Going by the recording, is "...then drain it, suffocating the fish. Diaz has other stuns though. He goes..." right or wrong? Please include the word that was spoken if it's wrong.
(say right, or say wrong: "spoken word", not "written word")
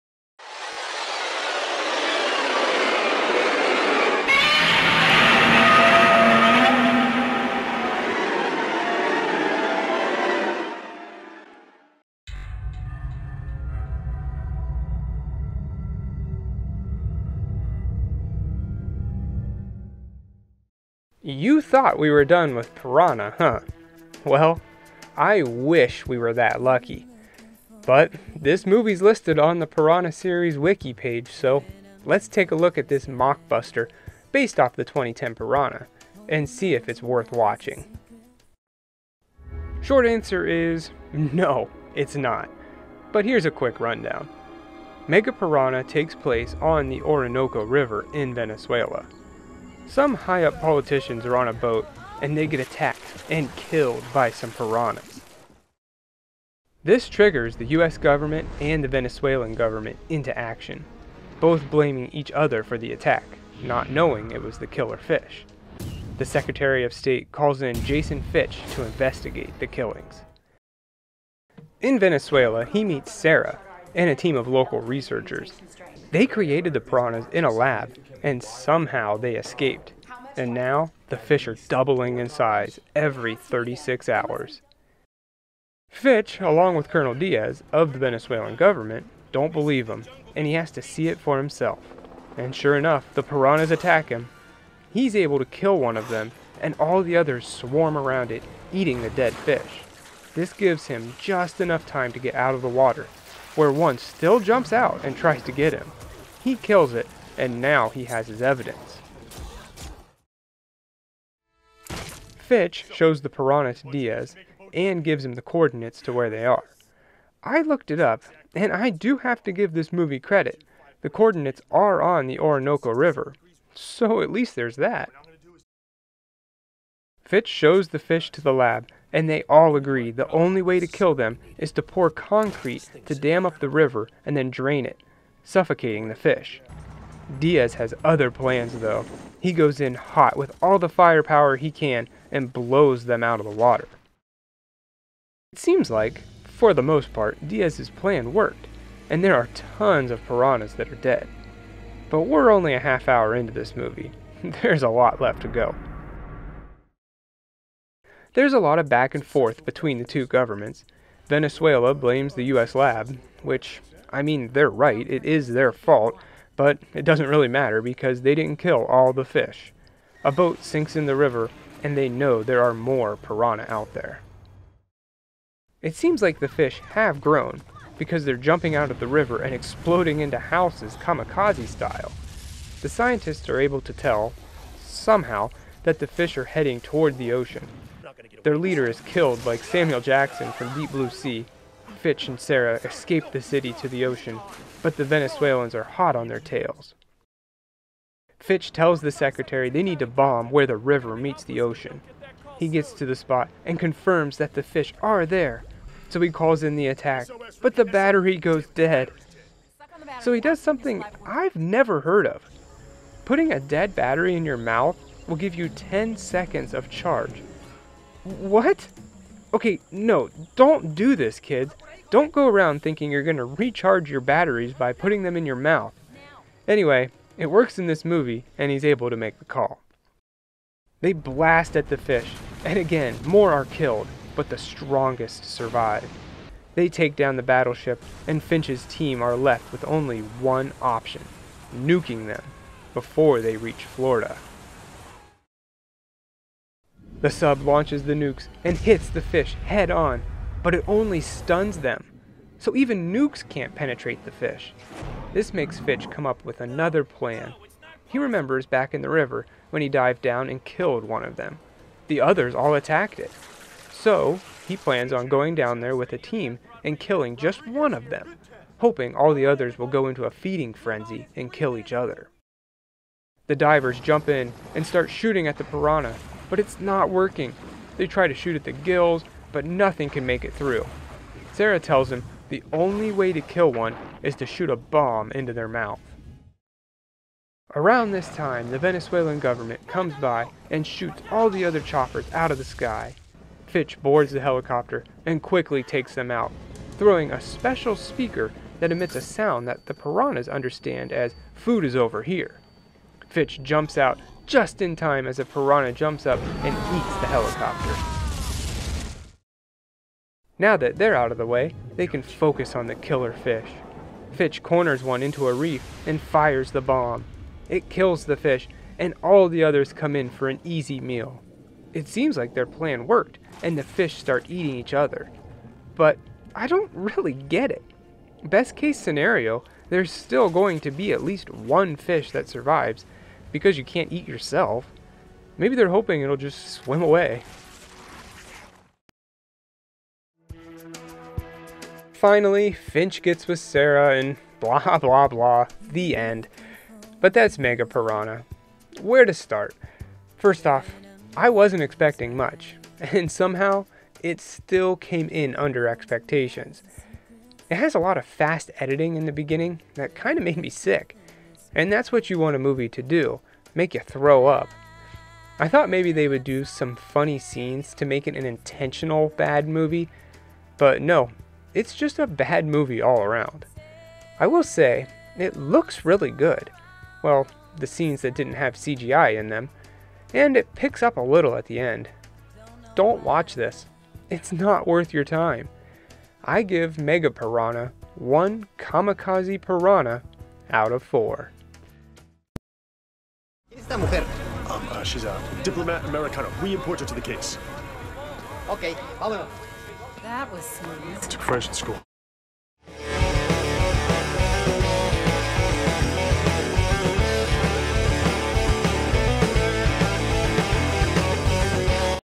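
wrong: "plans", not "stuns".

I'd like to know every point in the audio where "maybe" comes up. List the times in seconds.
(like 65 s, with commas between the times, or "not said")
335 s, 365 s.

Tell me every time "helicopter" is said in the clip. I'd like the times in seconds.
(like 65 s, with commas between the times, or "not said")
294 s, 307 s.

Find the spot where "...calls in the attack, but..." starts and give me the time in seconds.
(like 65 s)
206 s.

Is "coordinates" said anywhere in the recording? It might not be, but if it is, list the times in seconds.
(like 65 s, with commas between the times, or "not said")
115 s, 121 s.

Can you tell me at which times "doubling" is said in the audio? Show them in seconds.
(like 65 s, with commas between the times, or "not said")
81 s.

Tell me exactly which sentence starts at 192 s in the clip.
Fitch and Sarah escape the city to the ocean, but the Venezuelans are hot on their tails.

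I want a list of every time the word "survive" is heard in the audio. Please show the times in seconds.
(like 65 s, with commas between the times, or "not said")
235 s, 332 s.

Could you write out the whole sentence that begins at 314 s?
Fitch corners one into a reef and fires the bomb.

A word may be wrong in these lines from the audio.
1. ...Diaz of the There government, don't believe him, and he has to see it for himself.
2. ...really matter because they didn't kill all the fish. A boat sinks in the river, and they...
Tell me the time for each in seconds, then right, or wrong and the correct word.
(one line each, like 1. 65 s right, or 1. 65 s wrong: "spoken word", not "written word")
1. 87 s wrong: "Venezuelan", not "There"
2. 167 s right.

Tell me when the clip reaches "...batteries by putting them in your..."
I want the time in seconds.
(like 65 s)
224 s.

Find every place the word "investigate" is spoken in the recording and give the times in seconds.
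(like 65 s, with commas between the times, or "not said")
68 s.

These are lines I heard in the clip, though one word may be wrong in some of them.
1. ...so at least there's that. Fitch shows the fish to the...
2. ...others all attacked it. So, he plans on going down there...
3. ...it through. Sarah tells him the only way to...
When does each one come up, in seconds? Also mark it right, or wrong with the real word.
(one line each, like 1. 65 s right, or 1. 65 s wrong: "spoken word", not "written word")
1. 123 s right
2. 262 s right
3. 280 s right.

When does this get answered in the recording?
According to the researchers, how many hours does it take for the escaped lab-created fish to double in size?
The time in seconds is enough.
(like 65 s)
83 s.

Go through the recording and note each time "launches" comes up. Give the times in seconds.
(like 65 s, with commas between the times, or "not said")
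247 s.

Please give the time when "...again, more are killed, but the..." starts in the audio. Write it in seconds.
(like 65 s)
232 s.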